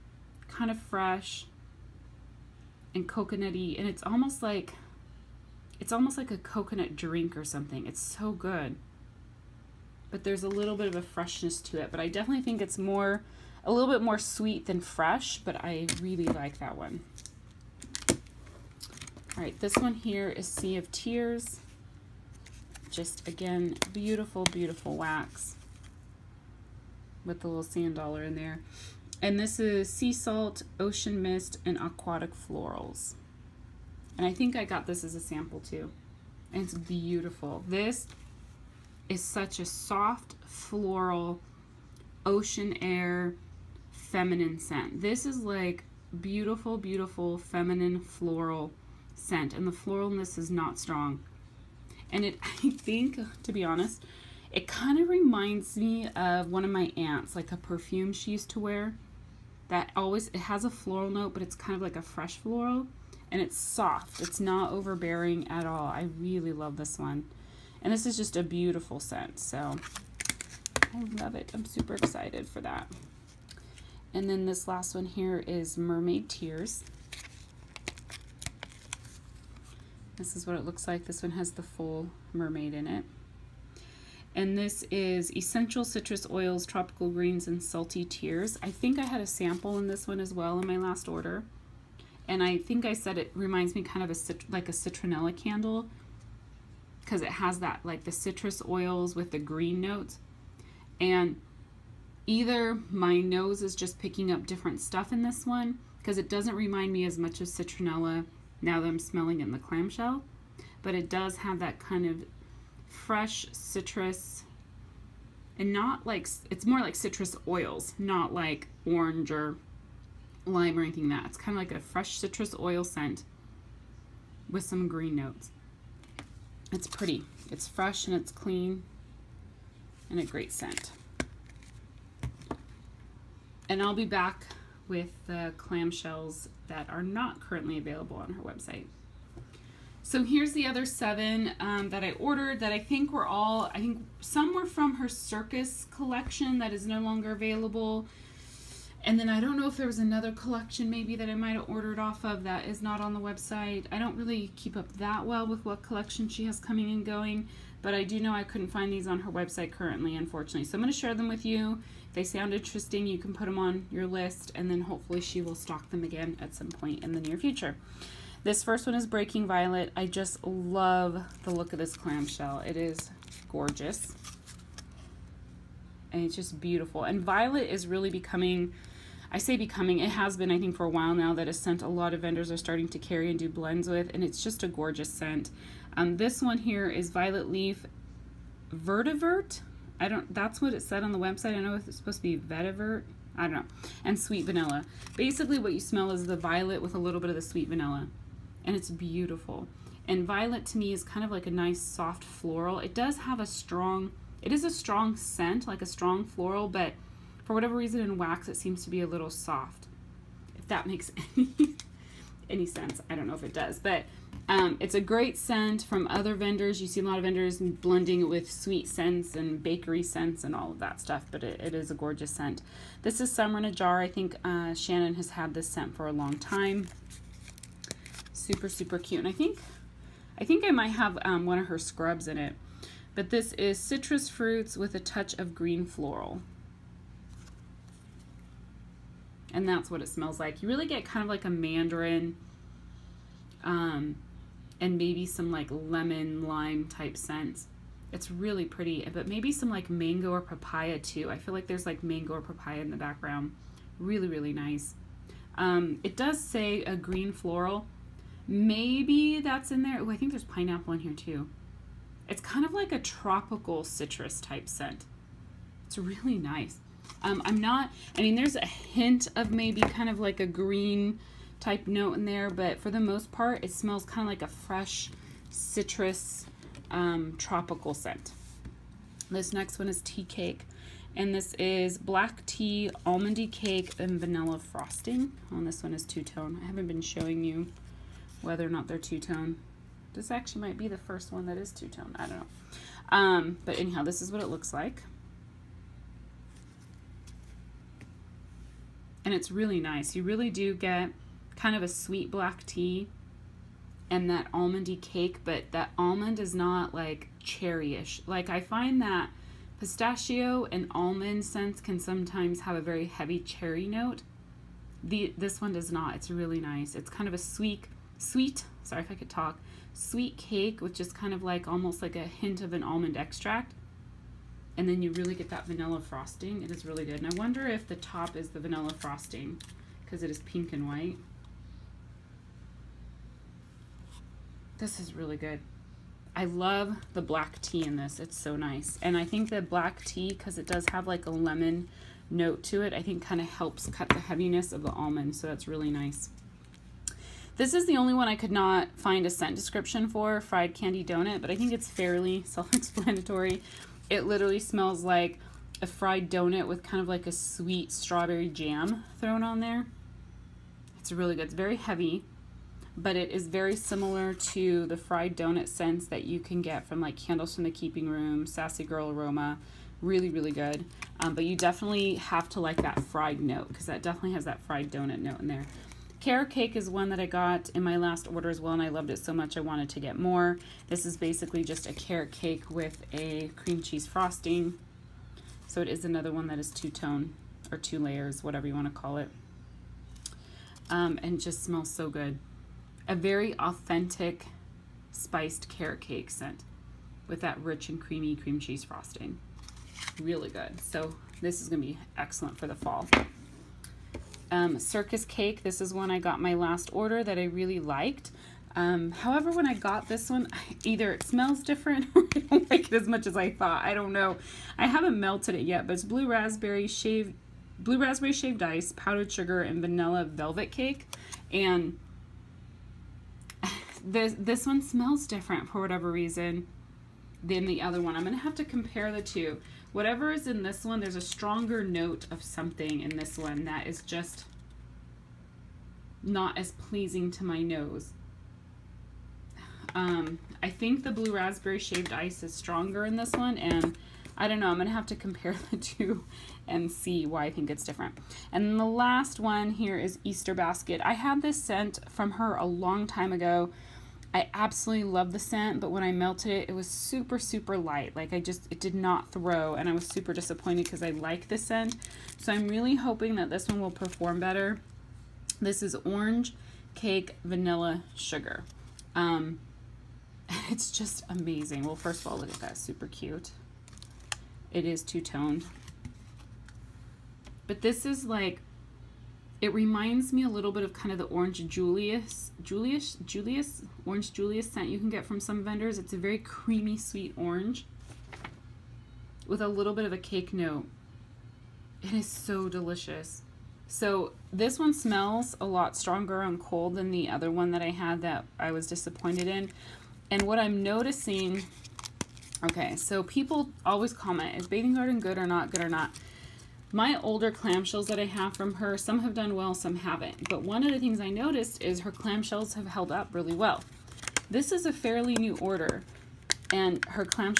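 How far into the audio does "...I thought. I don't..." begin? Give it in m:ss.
6:53.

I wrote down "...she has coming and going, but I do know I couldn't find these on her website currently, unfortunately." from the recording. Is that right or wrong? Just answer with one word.
right.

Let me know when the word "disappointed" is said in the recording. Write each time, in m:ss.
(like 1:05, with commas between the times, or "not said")
7:40, 8:18.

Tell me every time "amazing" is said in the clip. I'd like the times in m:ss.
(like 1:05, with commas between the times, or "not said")
7:51.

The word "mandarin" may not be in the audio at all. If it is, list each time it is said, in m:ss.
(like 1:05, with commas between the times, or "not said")
4:01.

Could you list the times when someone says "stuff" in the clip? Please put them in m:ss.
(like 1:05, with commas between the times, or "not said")
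1:44, 3:41.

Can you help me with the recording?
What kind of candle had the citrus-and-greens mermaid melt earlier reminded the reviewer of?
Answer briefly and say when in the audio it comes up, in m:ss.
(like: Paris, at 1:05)
citronella candle, at 1:34.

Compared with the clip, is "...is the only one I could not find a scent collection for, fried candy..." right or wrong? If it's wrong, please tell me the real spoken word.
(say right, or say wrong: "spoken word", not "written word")
wrong: "description", not "collection".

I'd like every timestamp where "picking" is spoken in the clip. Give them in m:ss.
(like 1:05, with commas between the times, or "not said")
1:43.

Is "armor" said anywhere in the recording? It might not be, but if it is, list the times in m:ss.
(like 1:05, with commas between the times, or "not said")
not said.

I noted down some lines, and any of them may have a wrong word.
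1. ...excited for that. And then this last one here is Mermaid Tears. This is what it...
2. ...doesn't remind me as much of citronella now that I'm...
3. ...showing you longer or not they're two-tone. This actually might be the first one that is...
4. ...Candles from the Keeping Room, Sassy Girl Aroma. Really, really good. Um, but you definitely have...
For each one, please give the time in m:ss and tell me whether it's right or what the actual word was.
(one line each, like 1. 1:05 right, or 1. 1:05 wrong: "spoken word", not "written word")
1. 1:11 right
2. 1:46 right
3. 4:47 wrong: "whether", not "longer"
4. 6:07 right.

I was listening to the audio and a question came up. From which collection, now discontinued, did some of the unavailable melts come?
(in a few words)
circus collection.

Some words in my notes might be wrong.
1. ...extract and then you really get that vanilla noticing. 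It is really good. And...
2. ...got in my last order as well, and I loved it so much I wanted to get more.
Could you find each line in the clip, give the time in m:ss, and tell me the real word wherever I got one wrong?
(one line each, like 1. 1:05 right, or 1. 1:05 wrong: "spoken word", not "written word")
1. 5:23 wrong: "frosting", not "noticing"
2. 6:17 right.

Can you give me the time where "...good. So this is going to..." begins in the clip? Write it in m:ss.
6:40.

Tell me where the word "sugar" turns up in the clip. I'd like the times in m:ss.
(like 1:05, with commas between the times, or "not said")
6:59, 7:48.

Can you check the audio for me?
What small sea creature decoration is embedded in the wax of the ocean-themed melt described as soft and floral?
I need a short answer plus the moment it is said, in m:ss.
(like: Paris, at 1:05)
sand dollar, at 0:27.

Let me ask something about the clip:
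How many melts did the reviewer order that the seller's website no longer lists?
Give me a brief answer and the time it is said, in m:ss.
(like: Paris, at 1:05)
7, at 2:20.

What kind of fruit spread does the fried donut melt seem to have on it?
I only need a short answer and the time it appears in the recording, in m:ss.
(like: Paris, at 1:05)
strawberry jam, at 5:57.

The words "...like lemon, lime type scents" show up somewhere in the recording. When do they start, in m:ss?
4:05.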